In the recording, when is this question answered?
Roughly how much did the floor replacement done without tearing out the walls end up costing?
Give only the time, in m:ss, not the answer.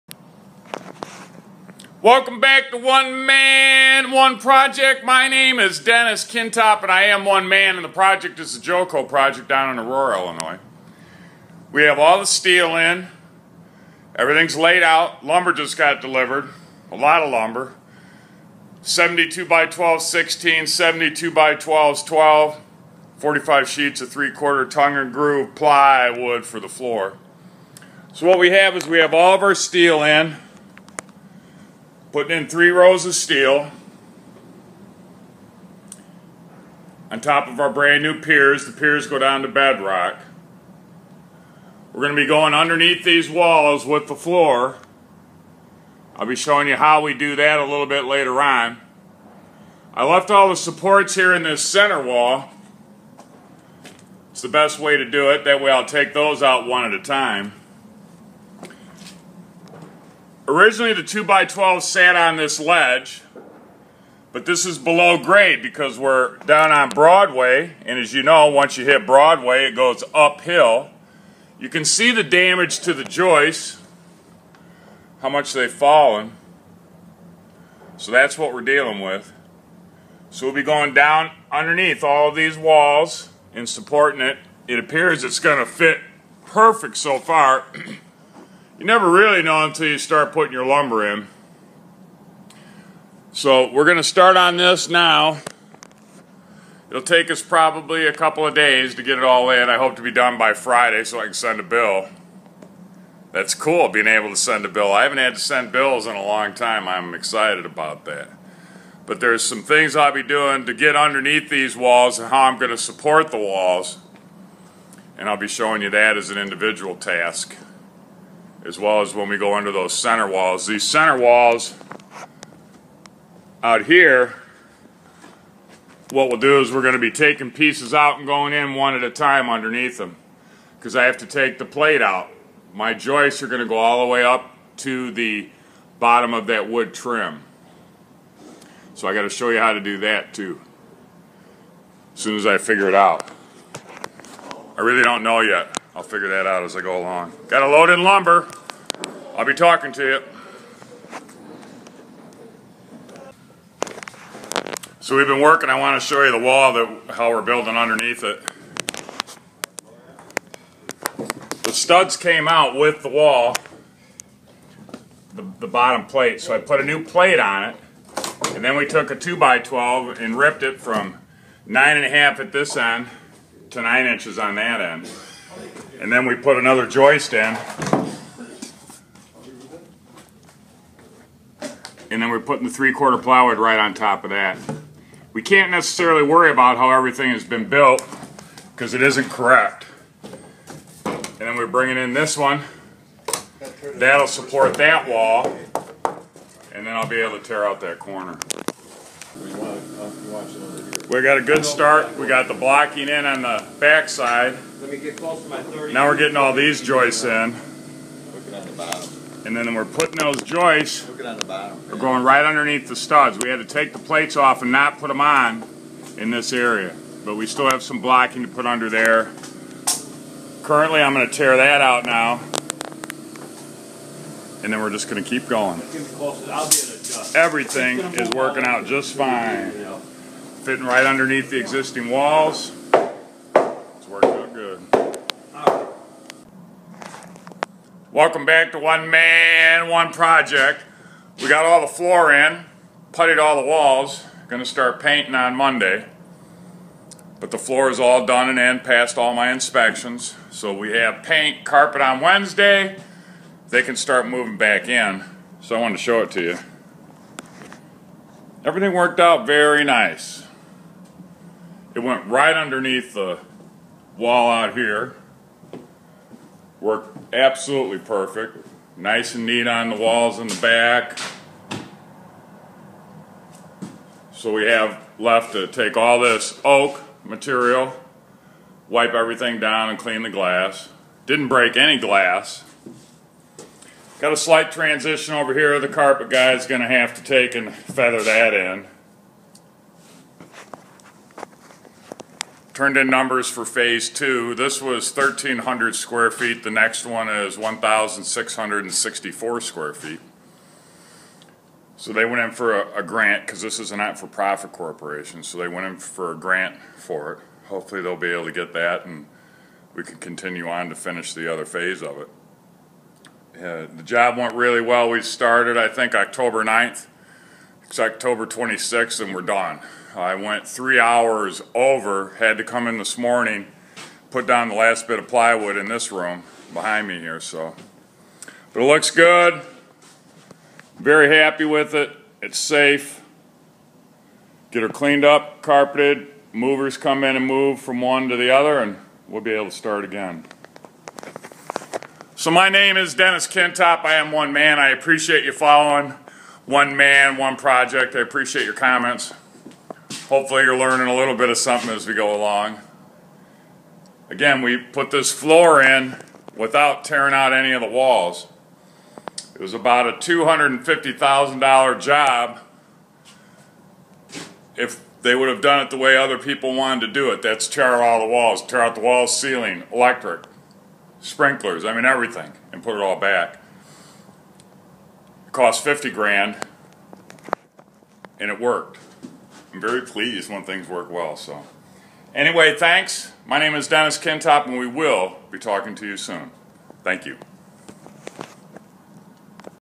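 6:15.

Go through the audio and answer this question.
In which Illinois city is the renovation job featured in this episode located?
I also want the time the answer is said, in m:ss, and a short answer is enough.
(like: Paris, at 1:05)
Aurora, at 0:09.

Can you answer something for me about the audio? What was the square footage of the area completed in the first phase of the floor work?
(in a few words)
1,300 square feet.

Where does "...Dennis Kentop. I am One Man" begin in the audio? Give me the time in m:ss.
5:43.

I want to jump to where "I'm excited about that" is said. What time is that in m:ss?
1:46.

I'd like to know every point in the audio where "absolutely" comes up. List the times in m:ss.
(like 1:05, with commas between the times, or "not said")
4:27.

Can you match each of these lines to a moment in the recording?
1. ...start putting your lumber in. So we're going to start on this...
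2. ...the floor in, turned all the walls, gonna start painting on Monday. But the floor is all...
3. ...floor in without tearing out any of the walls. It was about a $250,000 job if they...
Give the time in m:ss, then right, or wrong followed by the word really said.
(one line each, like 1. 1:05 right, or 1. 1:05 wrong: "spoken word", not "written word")
1. 1:29 right
2. 4:01 wrong: "putted", not "turned"
3. 5:55 right.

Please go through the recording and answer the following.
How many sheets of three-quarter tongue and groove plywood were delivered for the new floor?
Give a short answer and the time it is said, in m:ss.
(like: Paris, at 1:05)
45, at 0:23.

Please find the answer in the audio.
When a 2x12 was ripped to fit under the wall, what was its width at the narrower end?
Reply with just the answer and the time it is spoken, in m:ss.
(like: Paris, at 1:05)
9 inches, at 2:53.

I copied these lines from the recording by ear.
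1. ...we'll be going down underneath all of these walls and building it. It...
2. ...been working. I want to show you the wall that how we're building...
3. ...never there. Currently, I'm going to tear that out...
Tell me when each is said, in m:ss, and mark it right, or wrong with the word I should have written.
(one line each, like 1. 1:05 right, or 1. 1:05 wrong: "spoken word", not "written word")
1. 1:20 wrong: "supporting", not "building"
2. 2:35 right
3. 3:38 wrong: "under", not "never".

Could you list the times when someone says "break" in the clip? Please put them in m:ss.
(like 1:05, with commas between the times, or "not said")
4:41.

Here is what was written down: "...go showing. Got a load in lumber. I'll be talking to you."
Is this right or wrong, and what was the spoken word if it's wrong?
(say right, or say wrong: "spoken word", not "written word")
wrong: "along", not "showing".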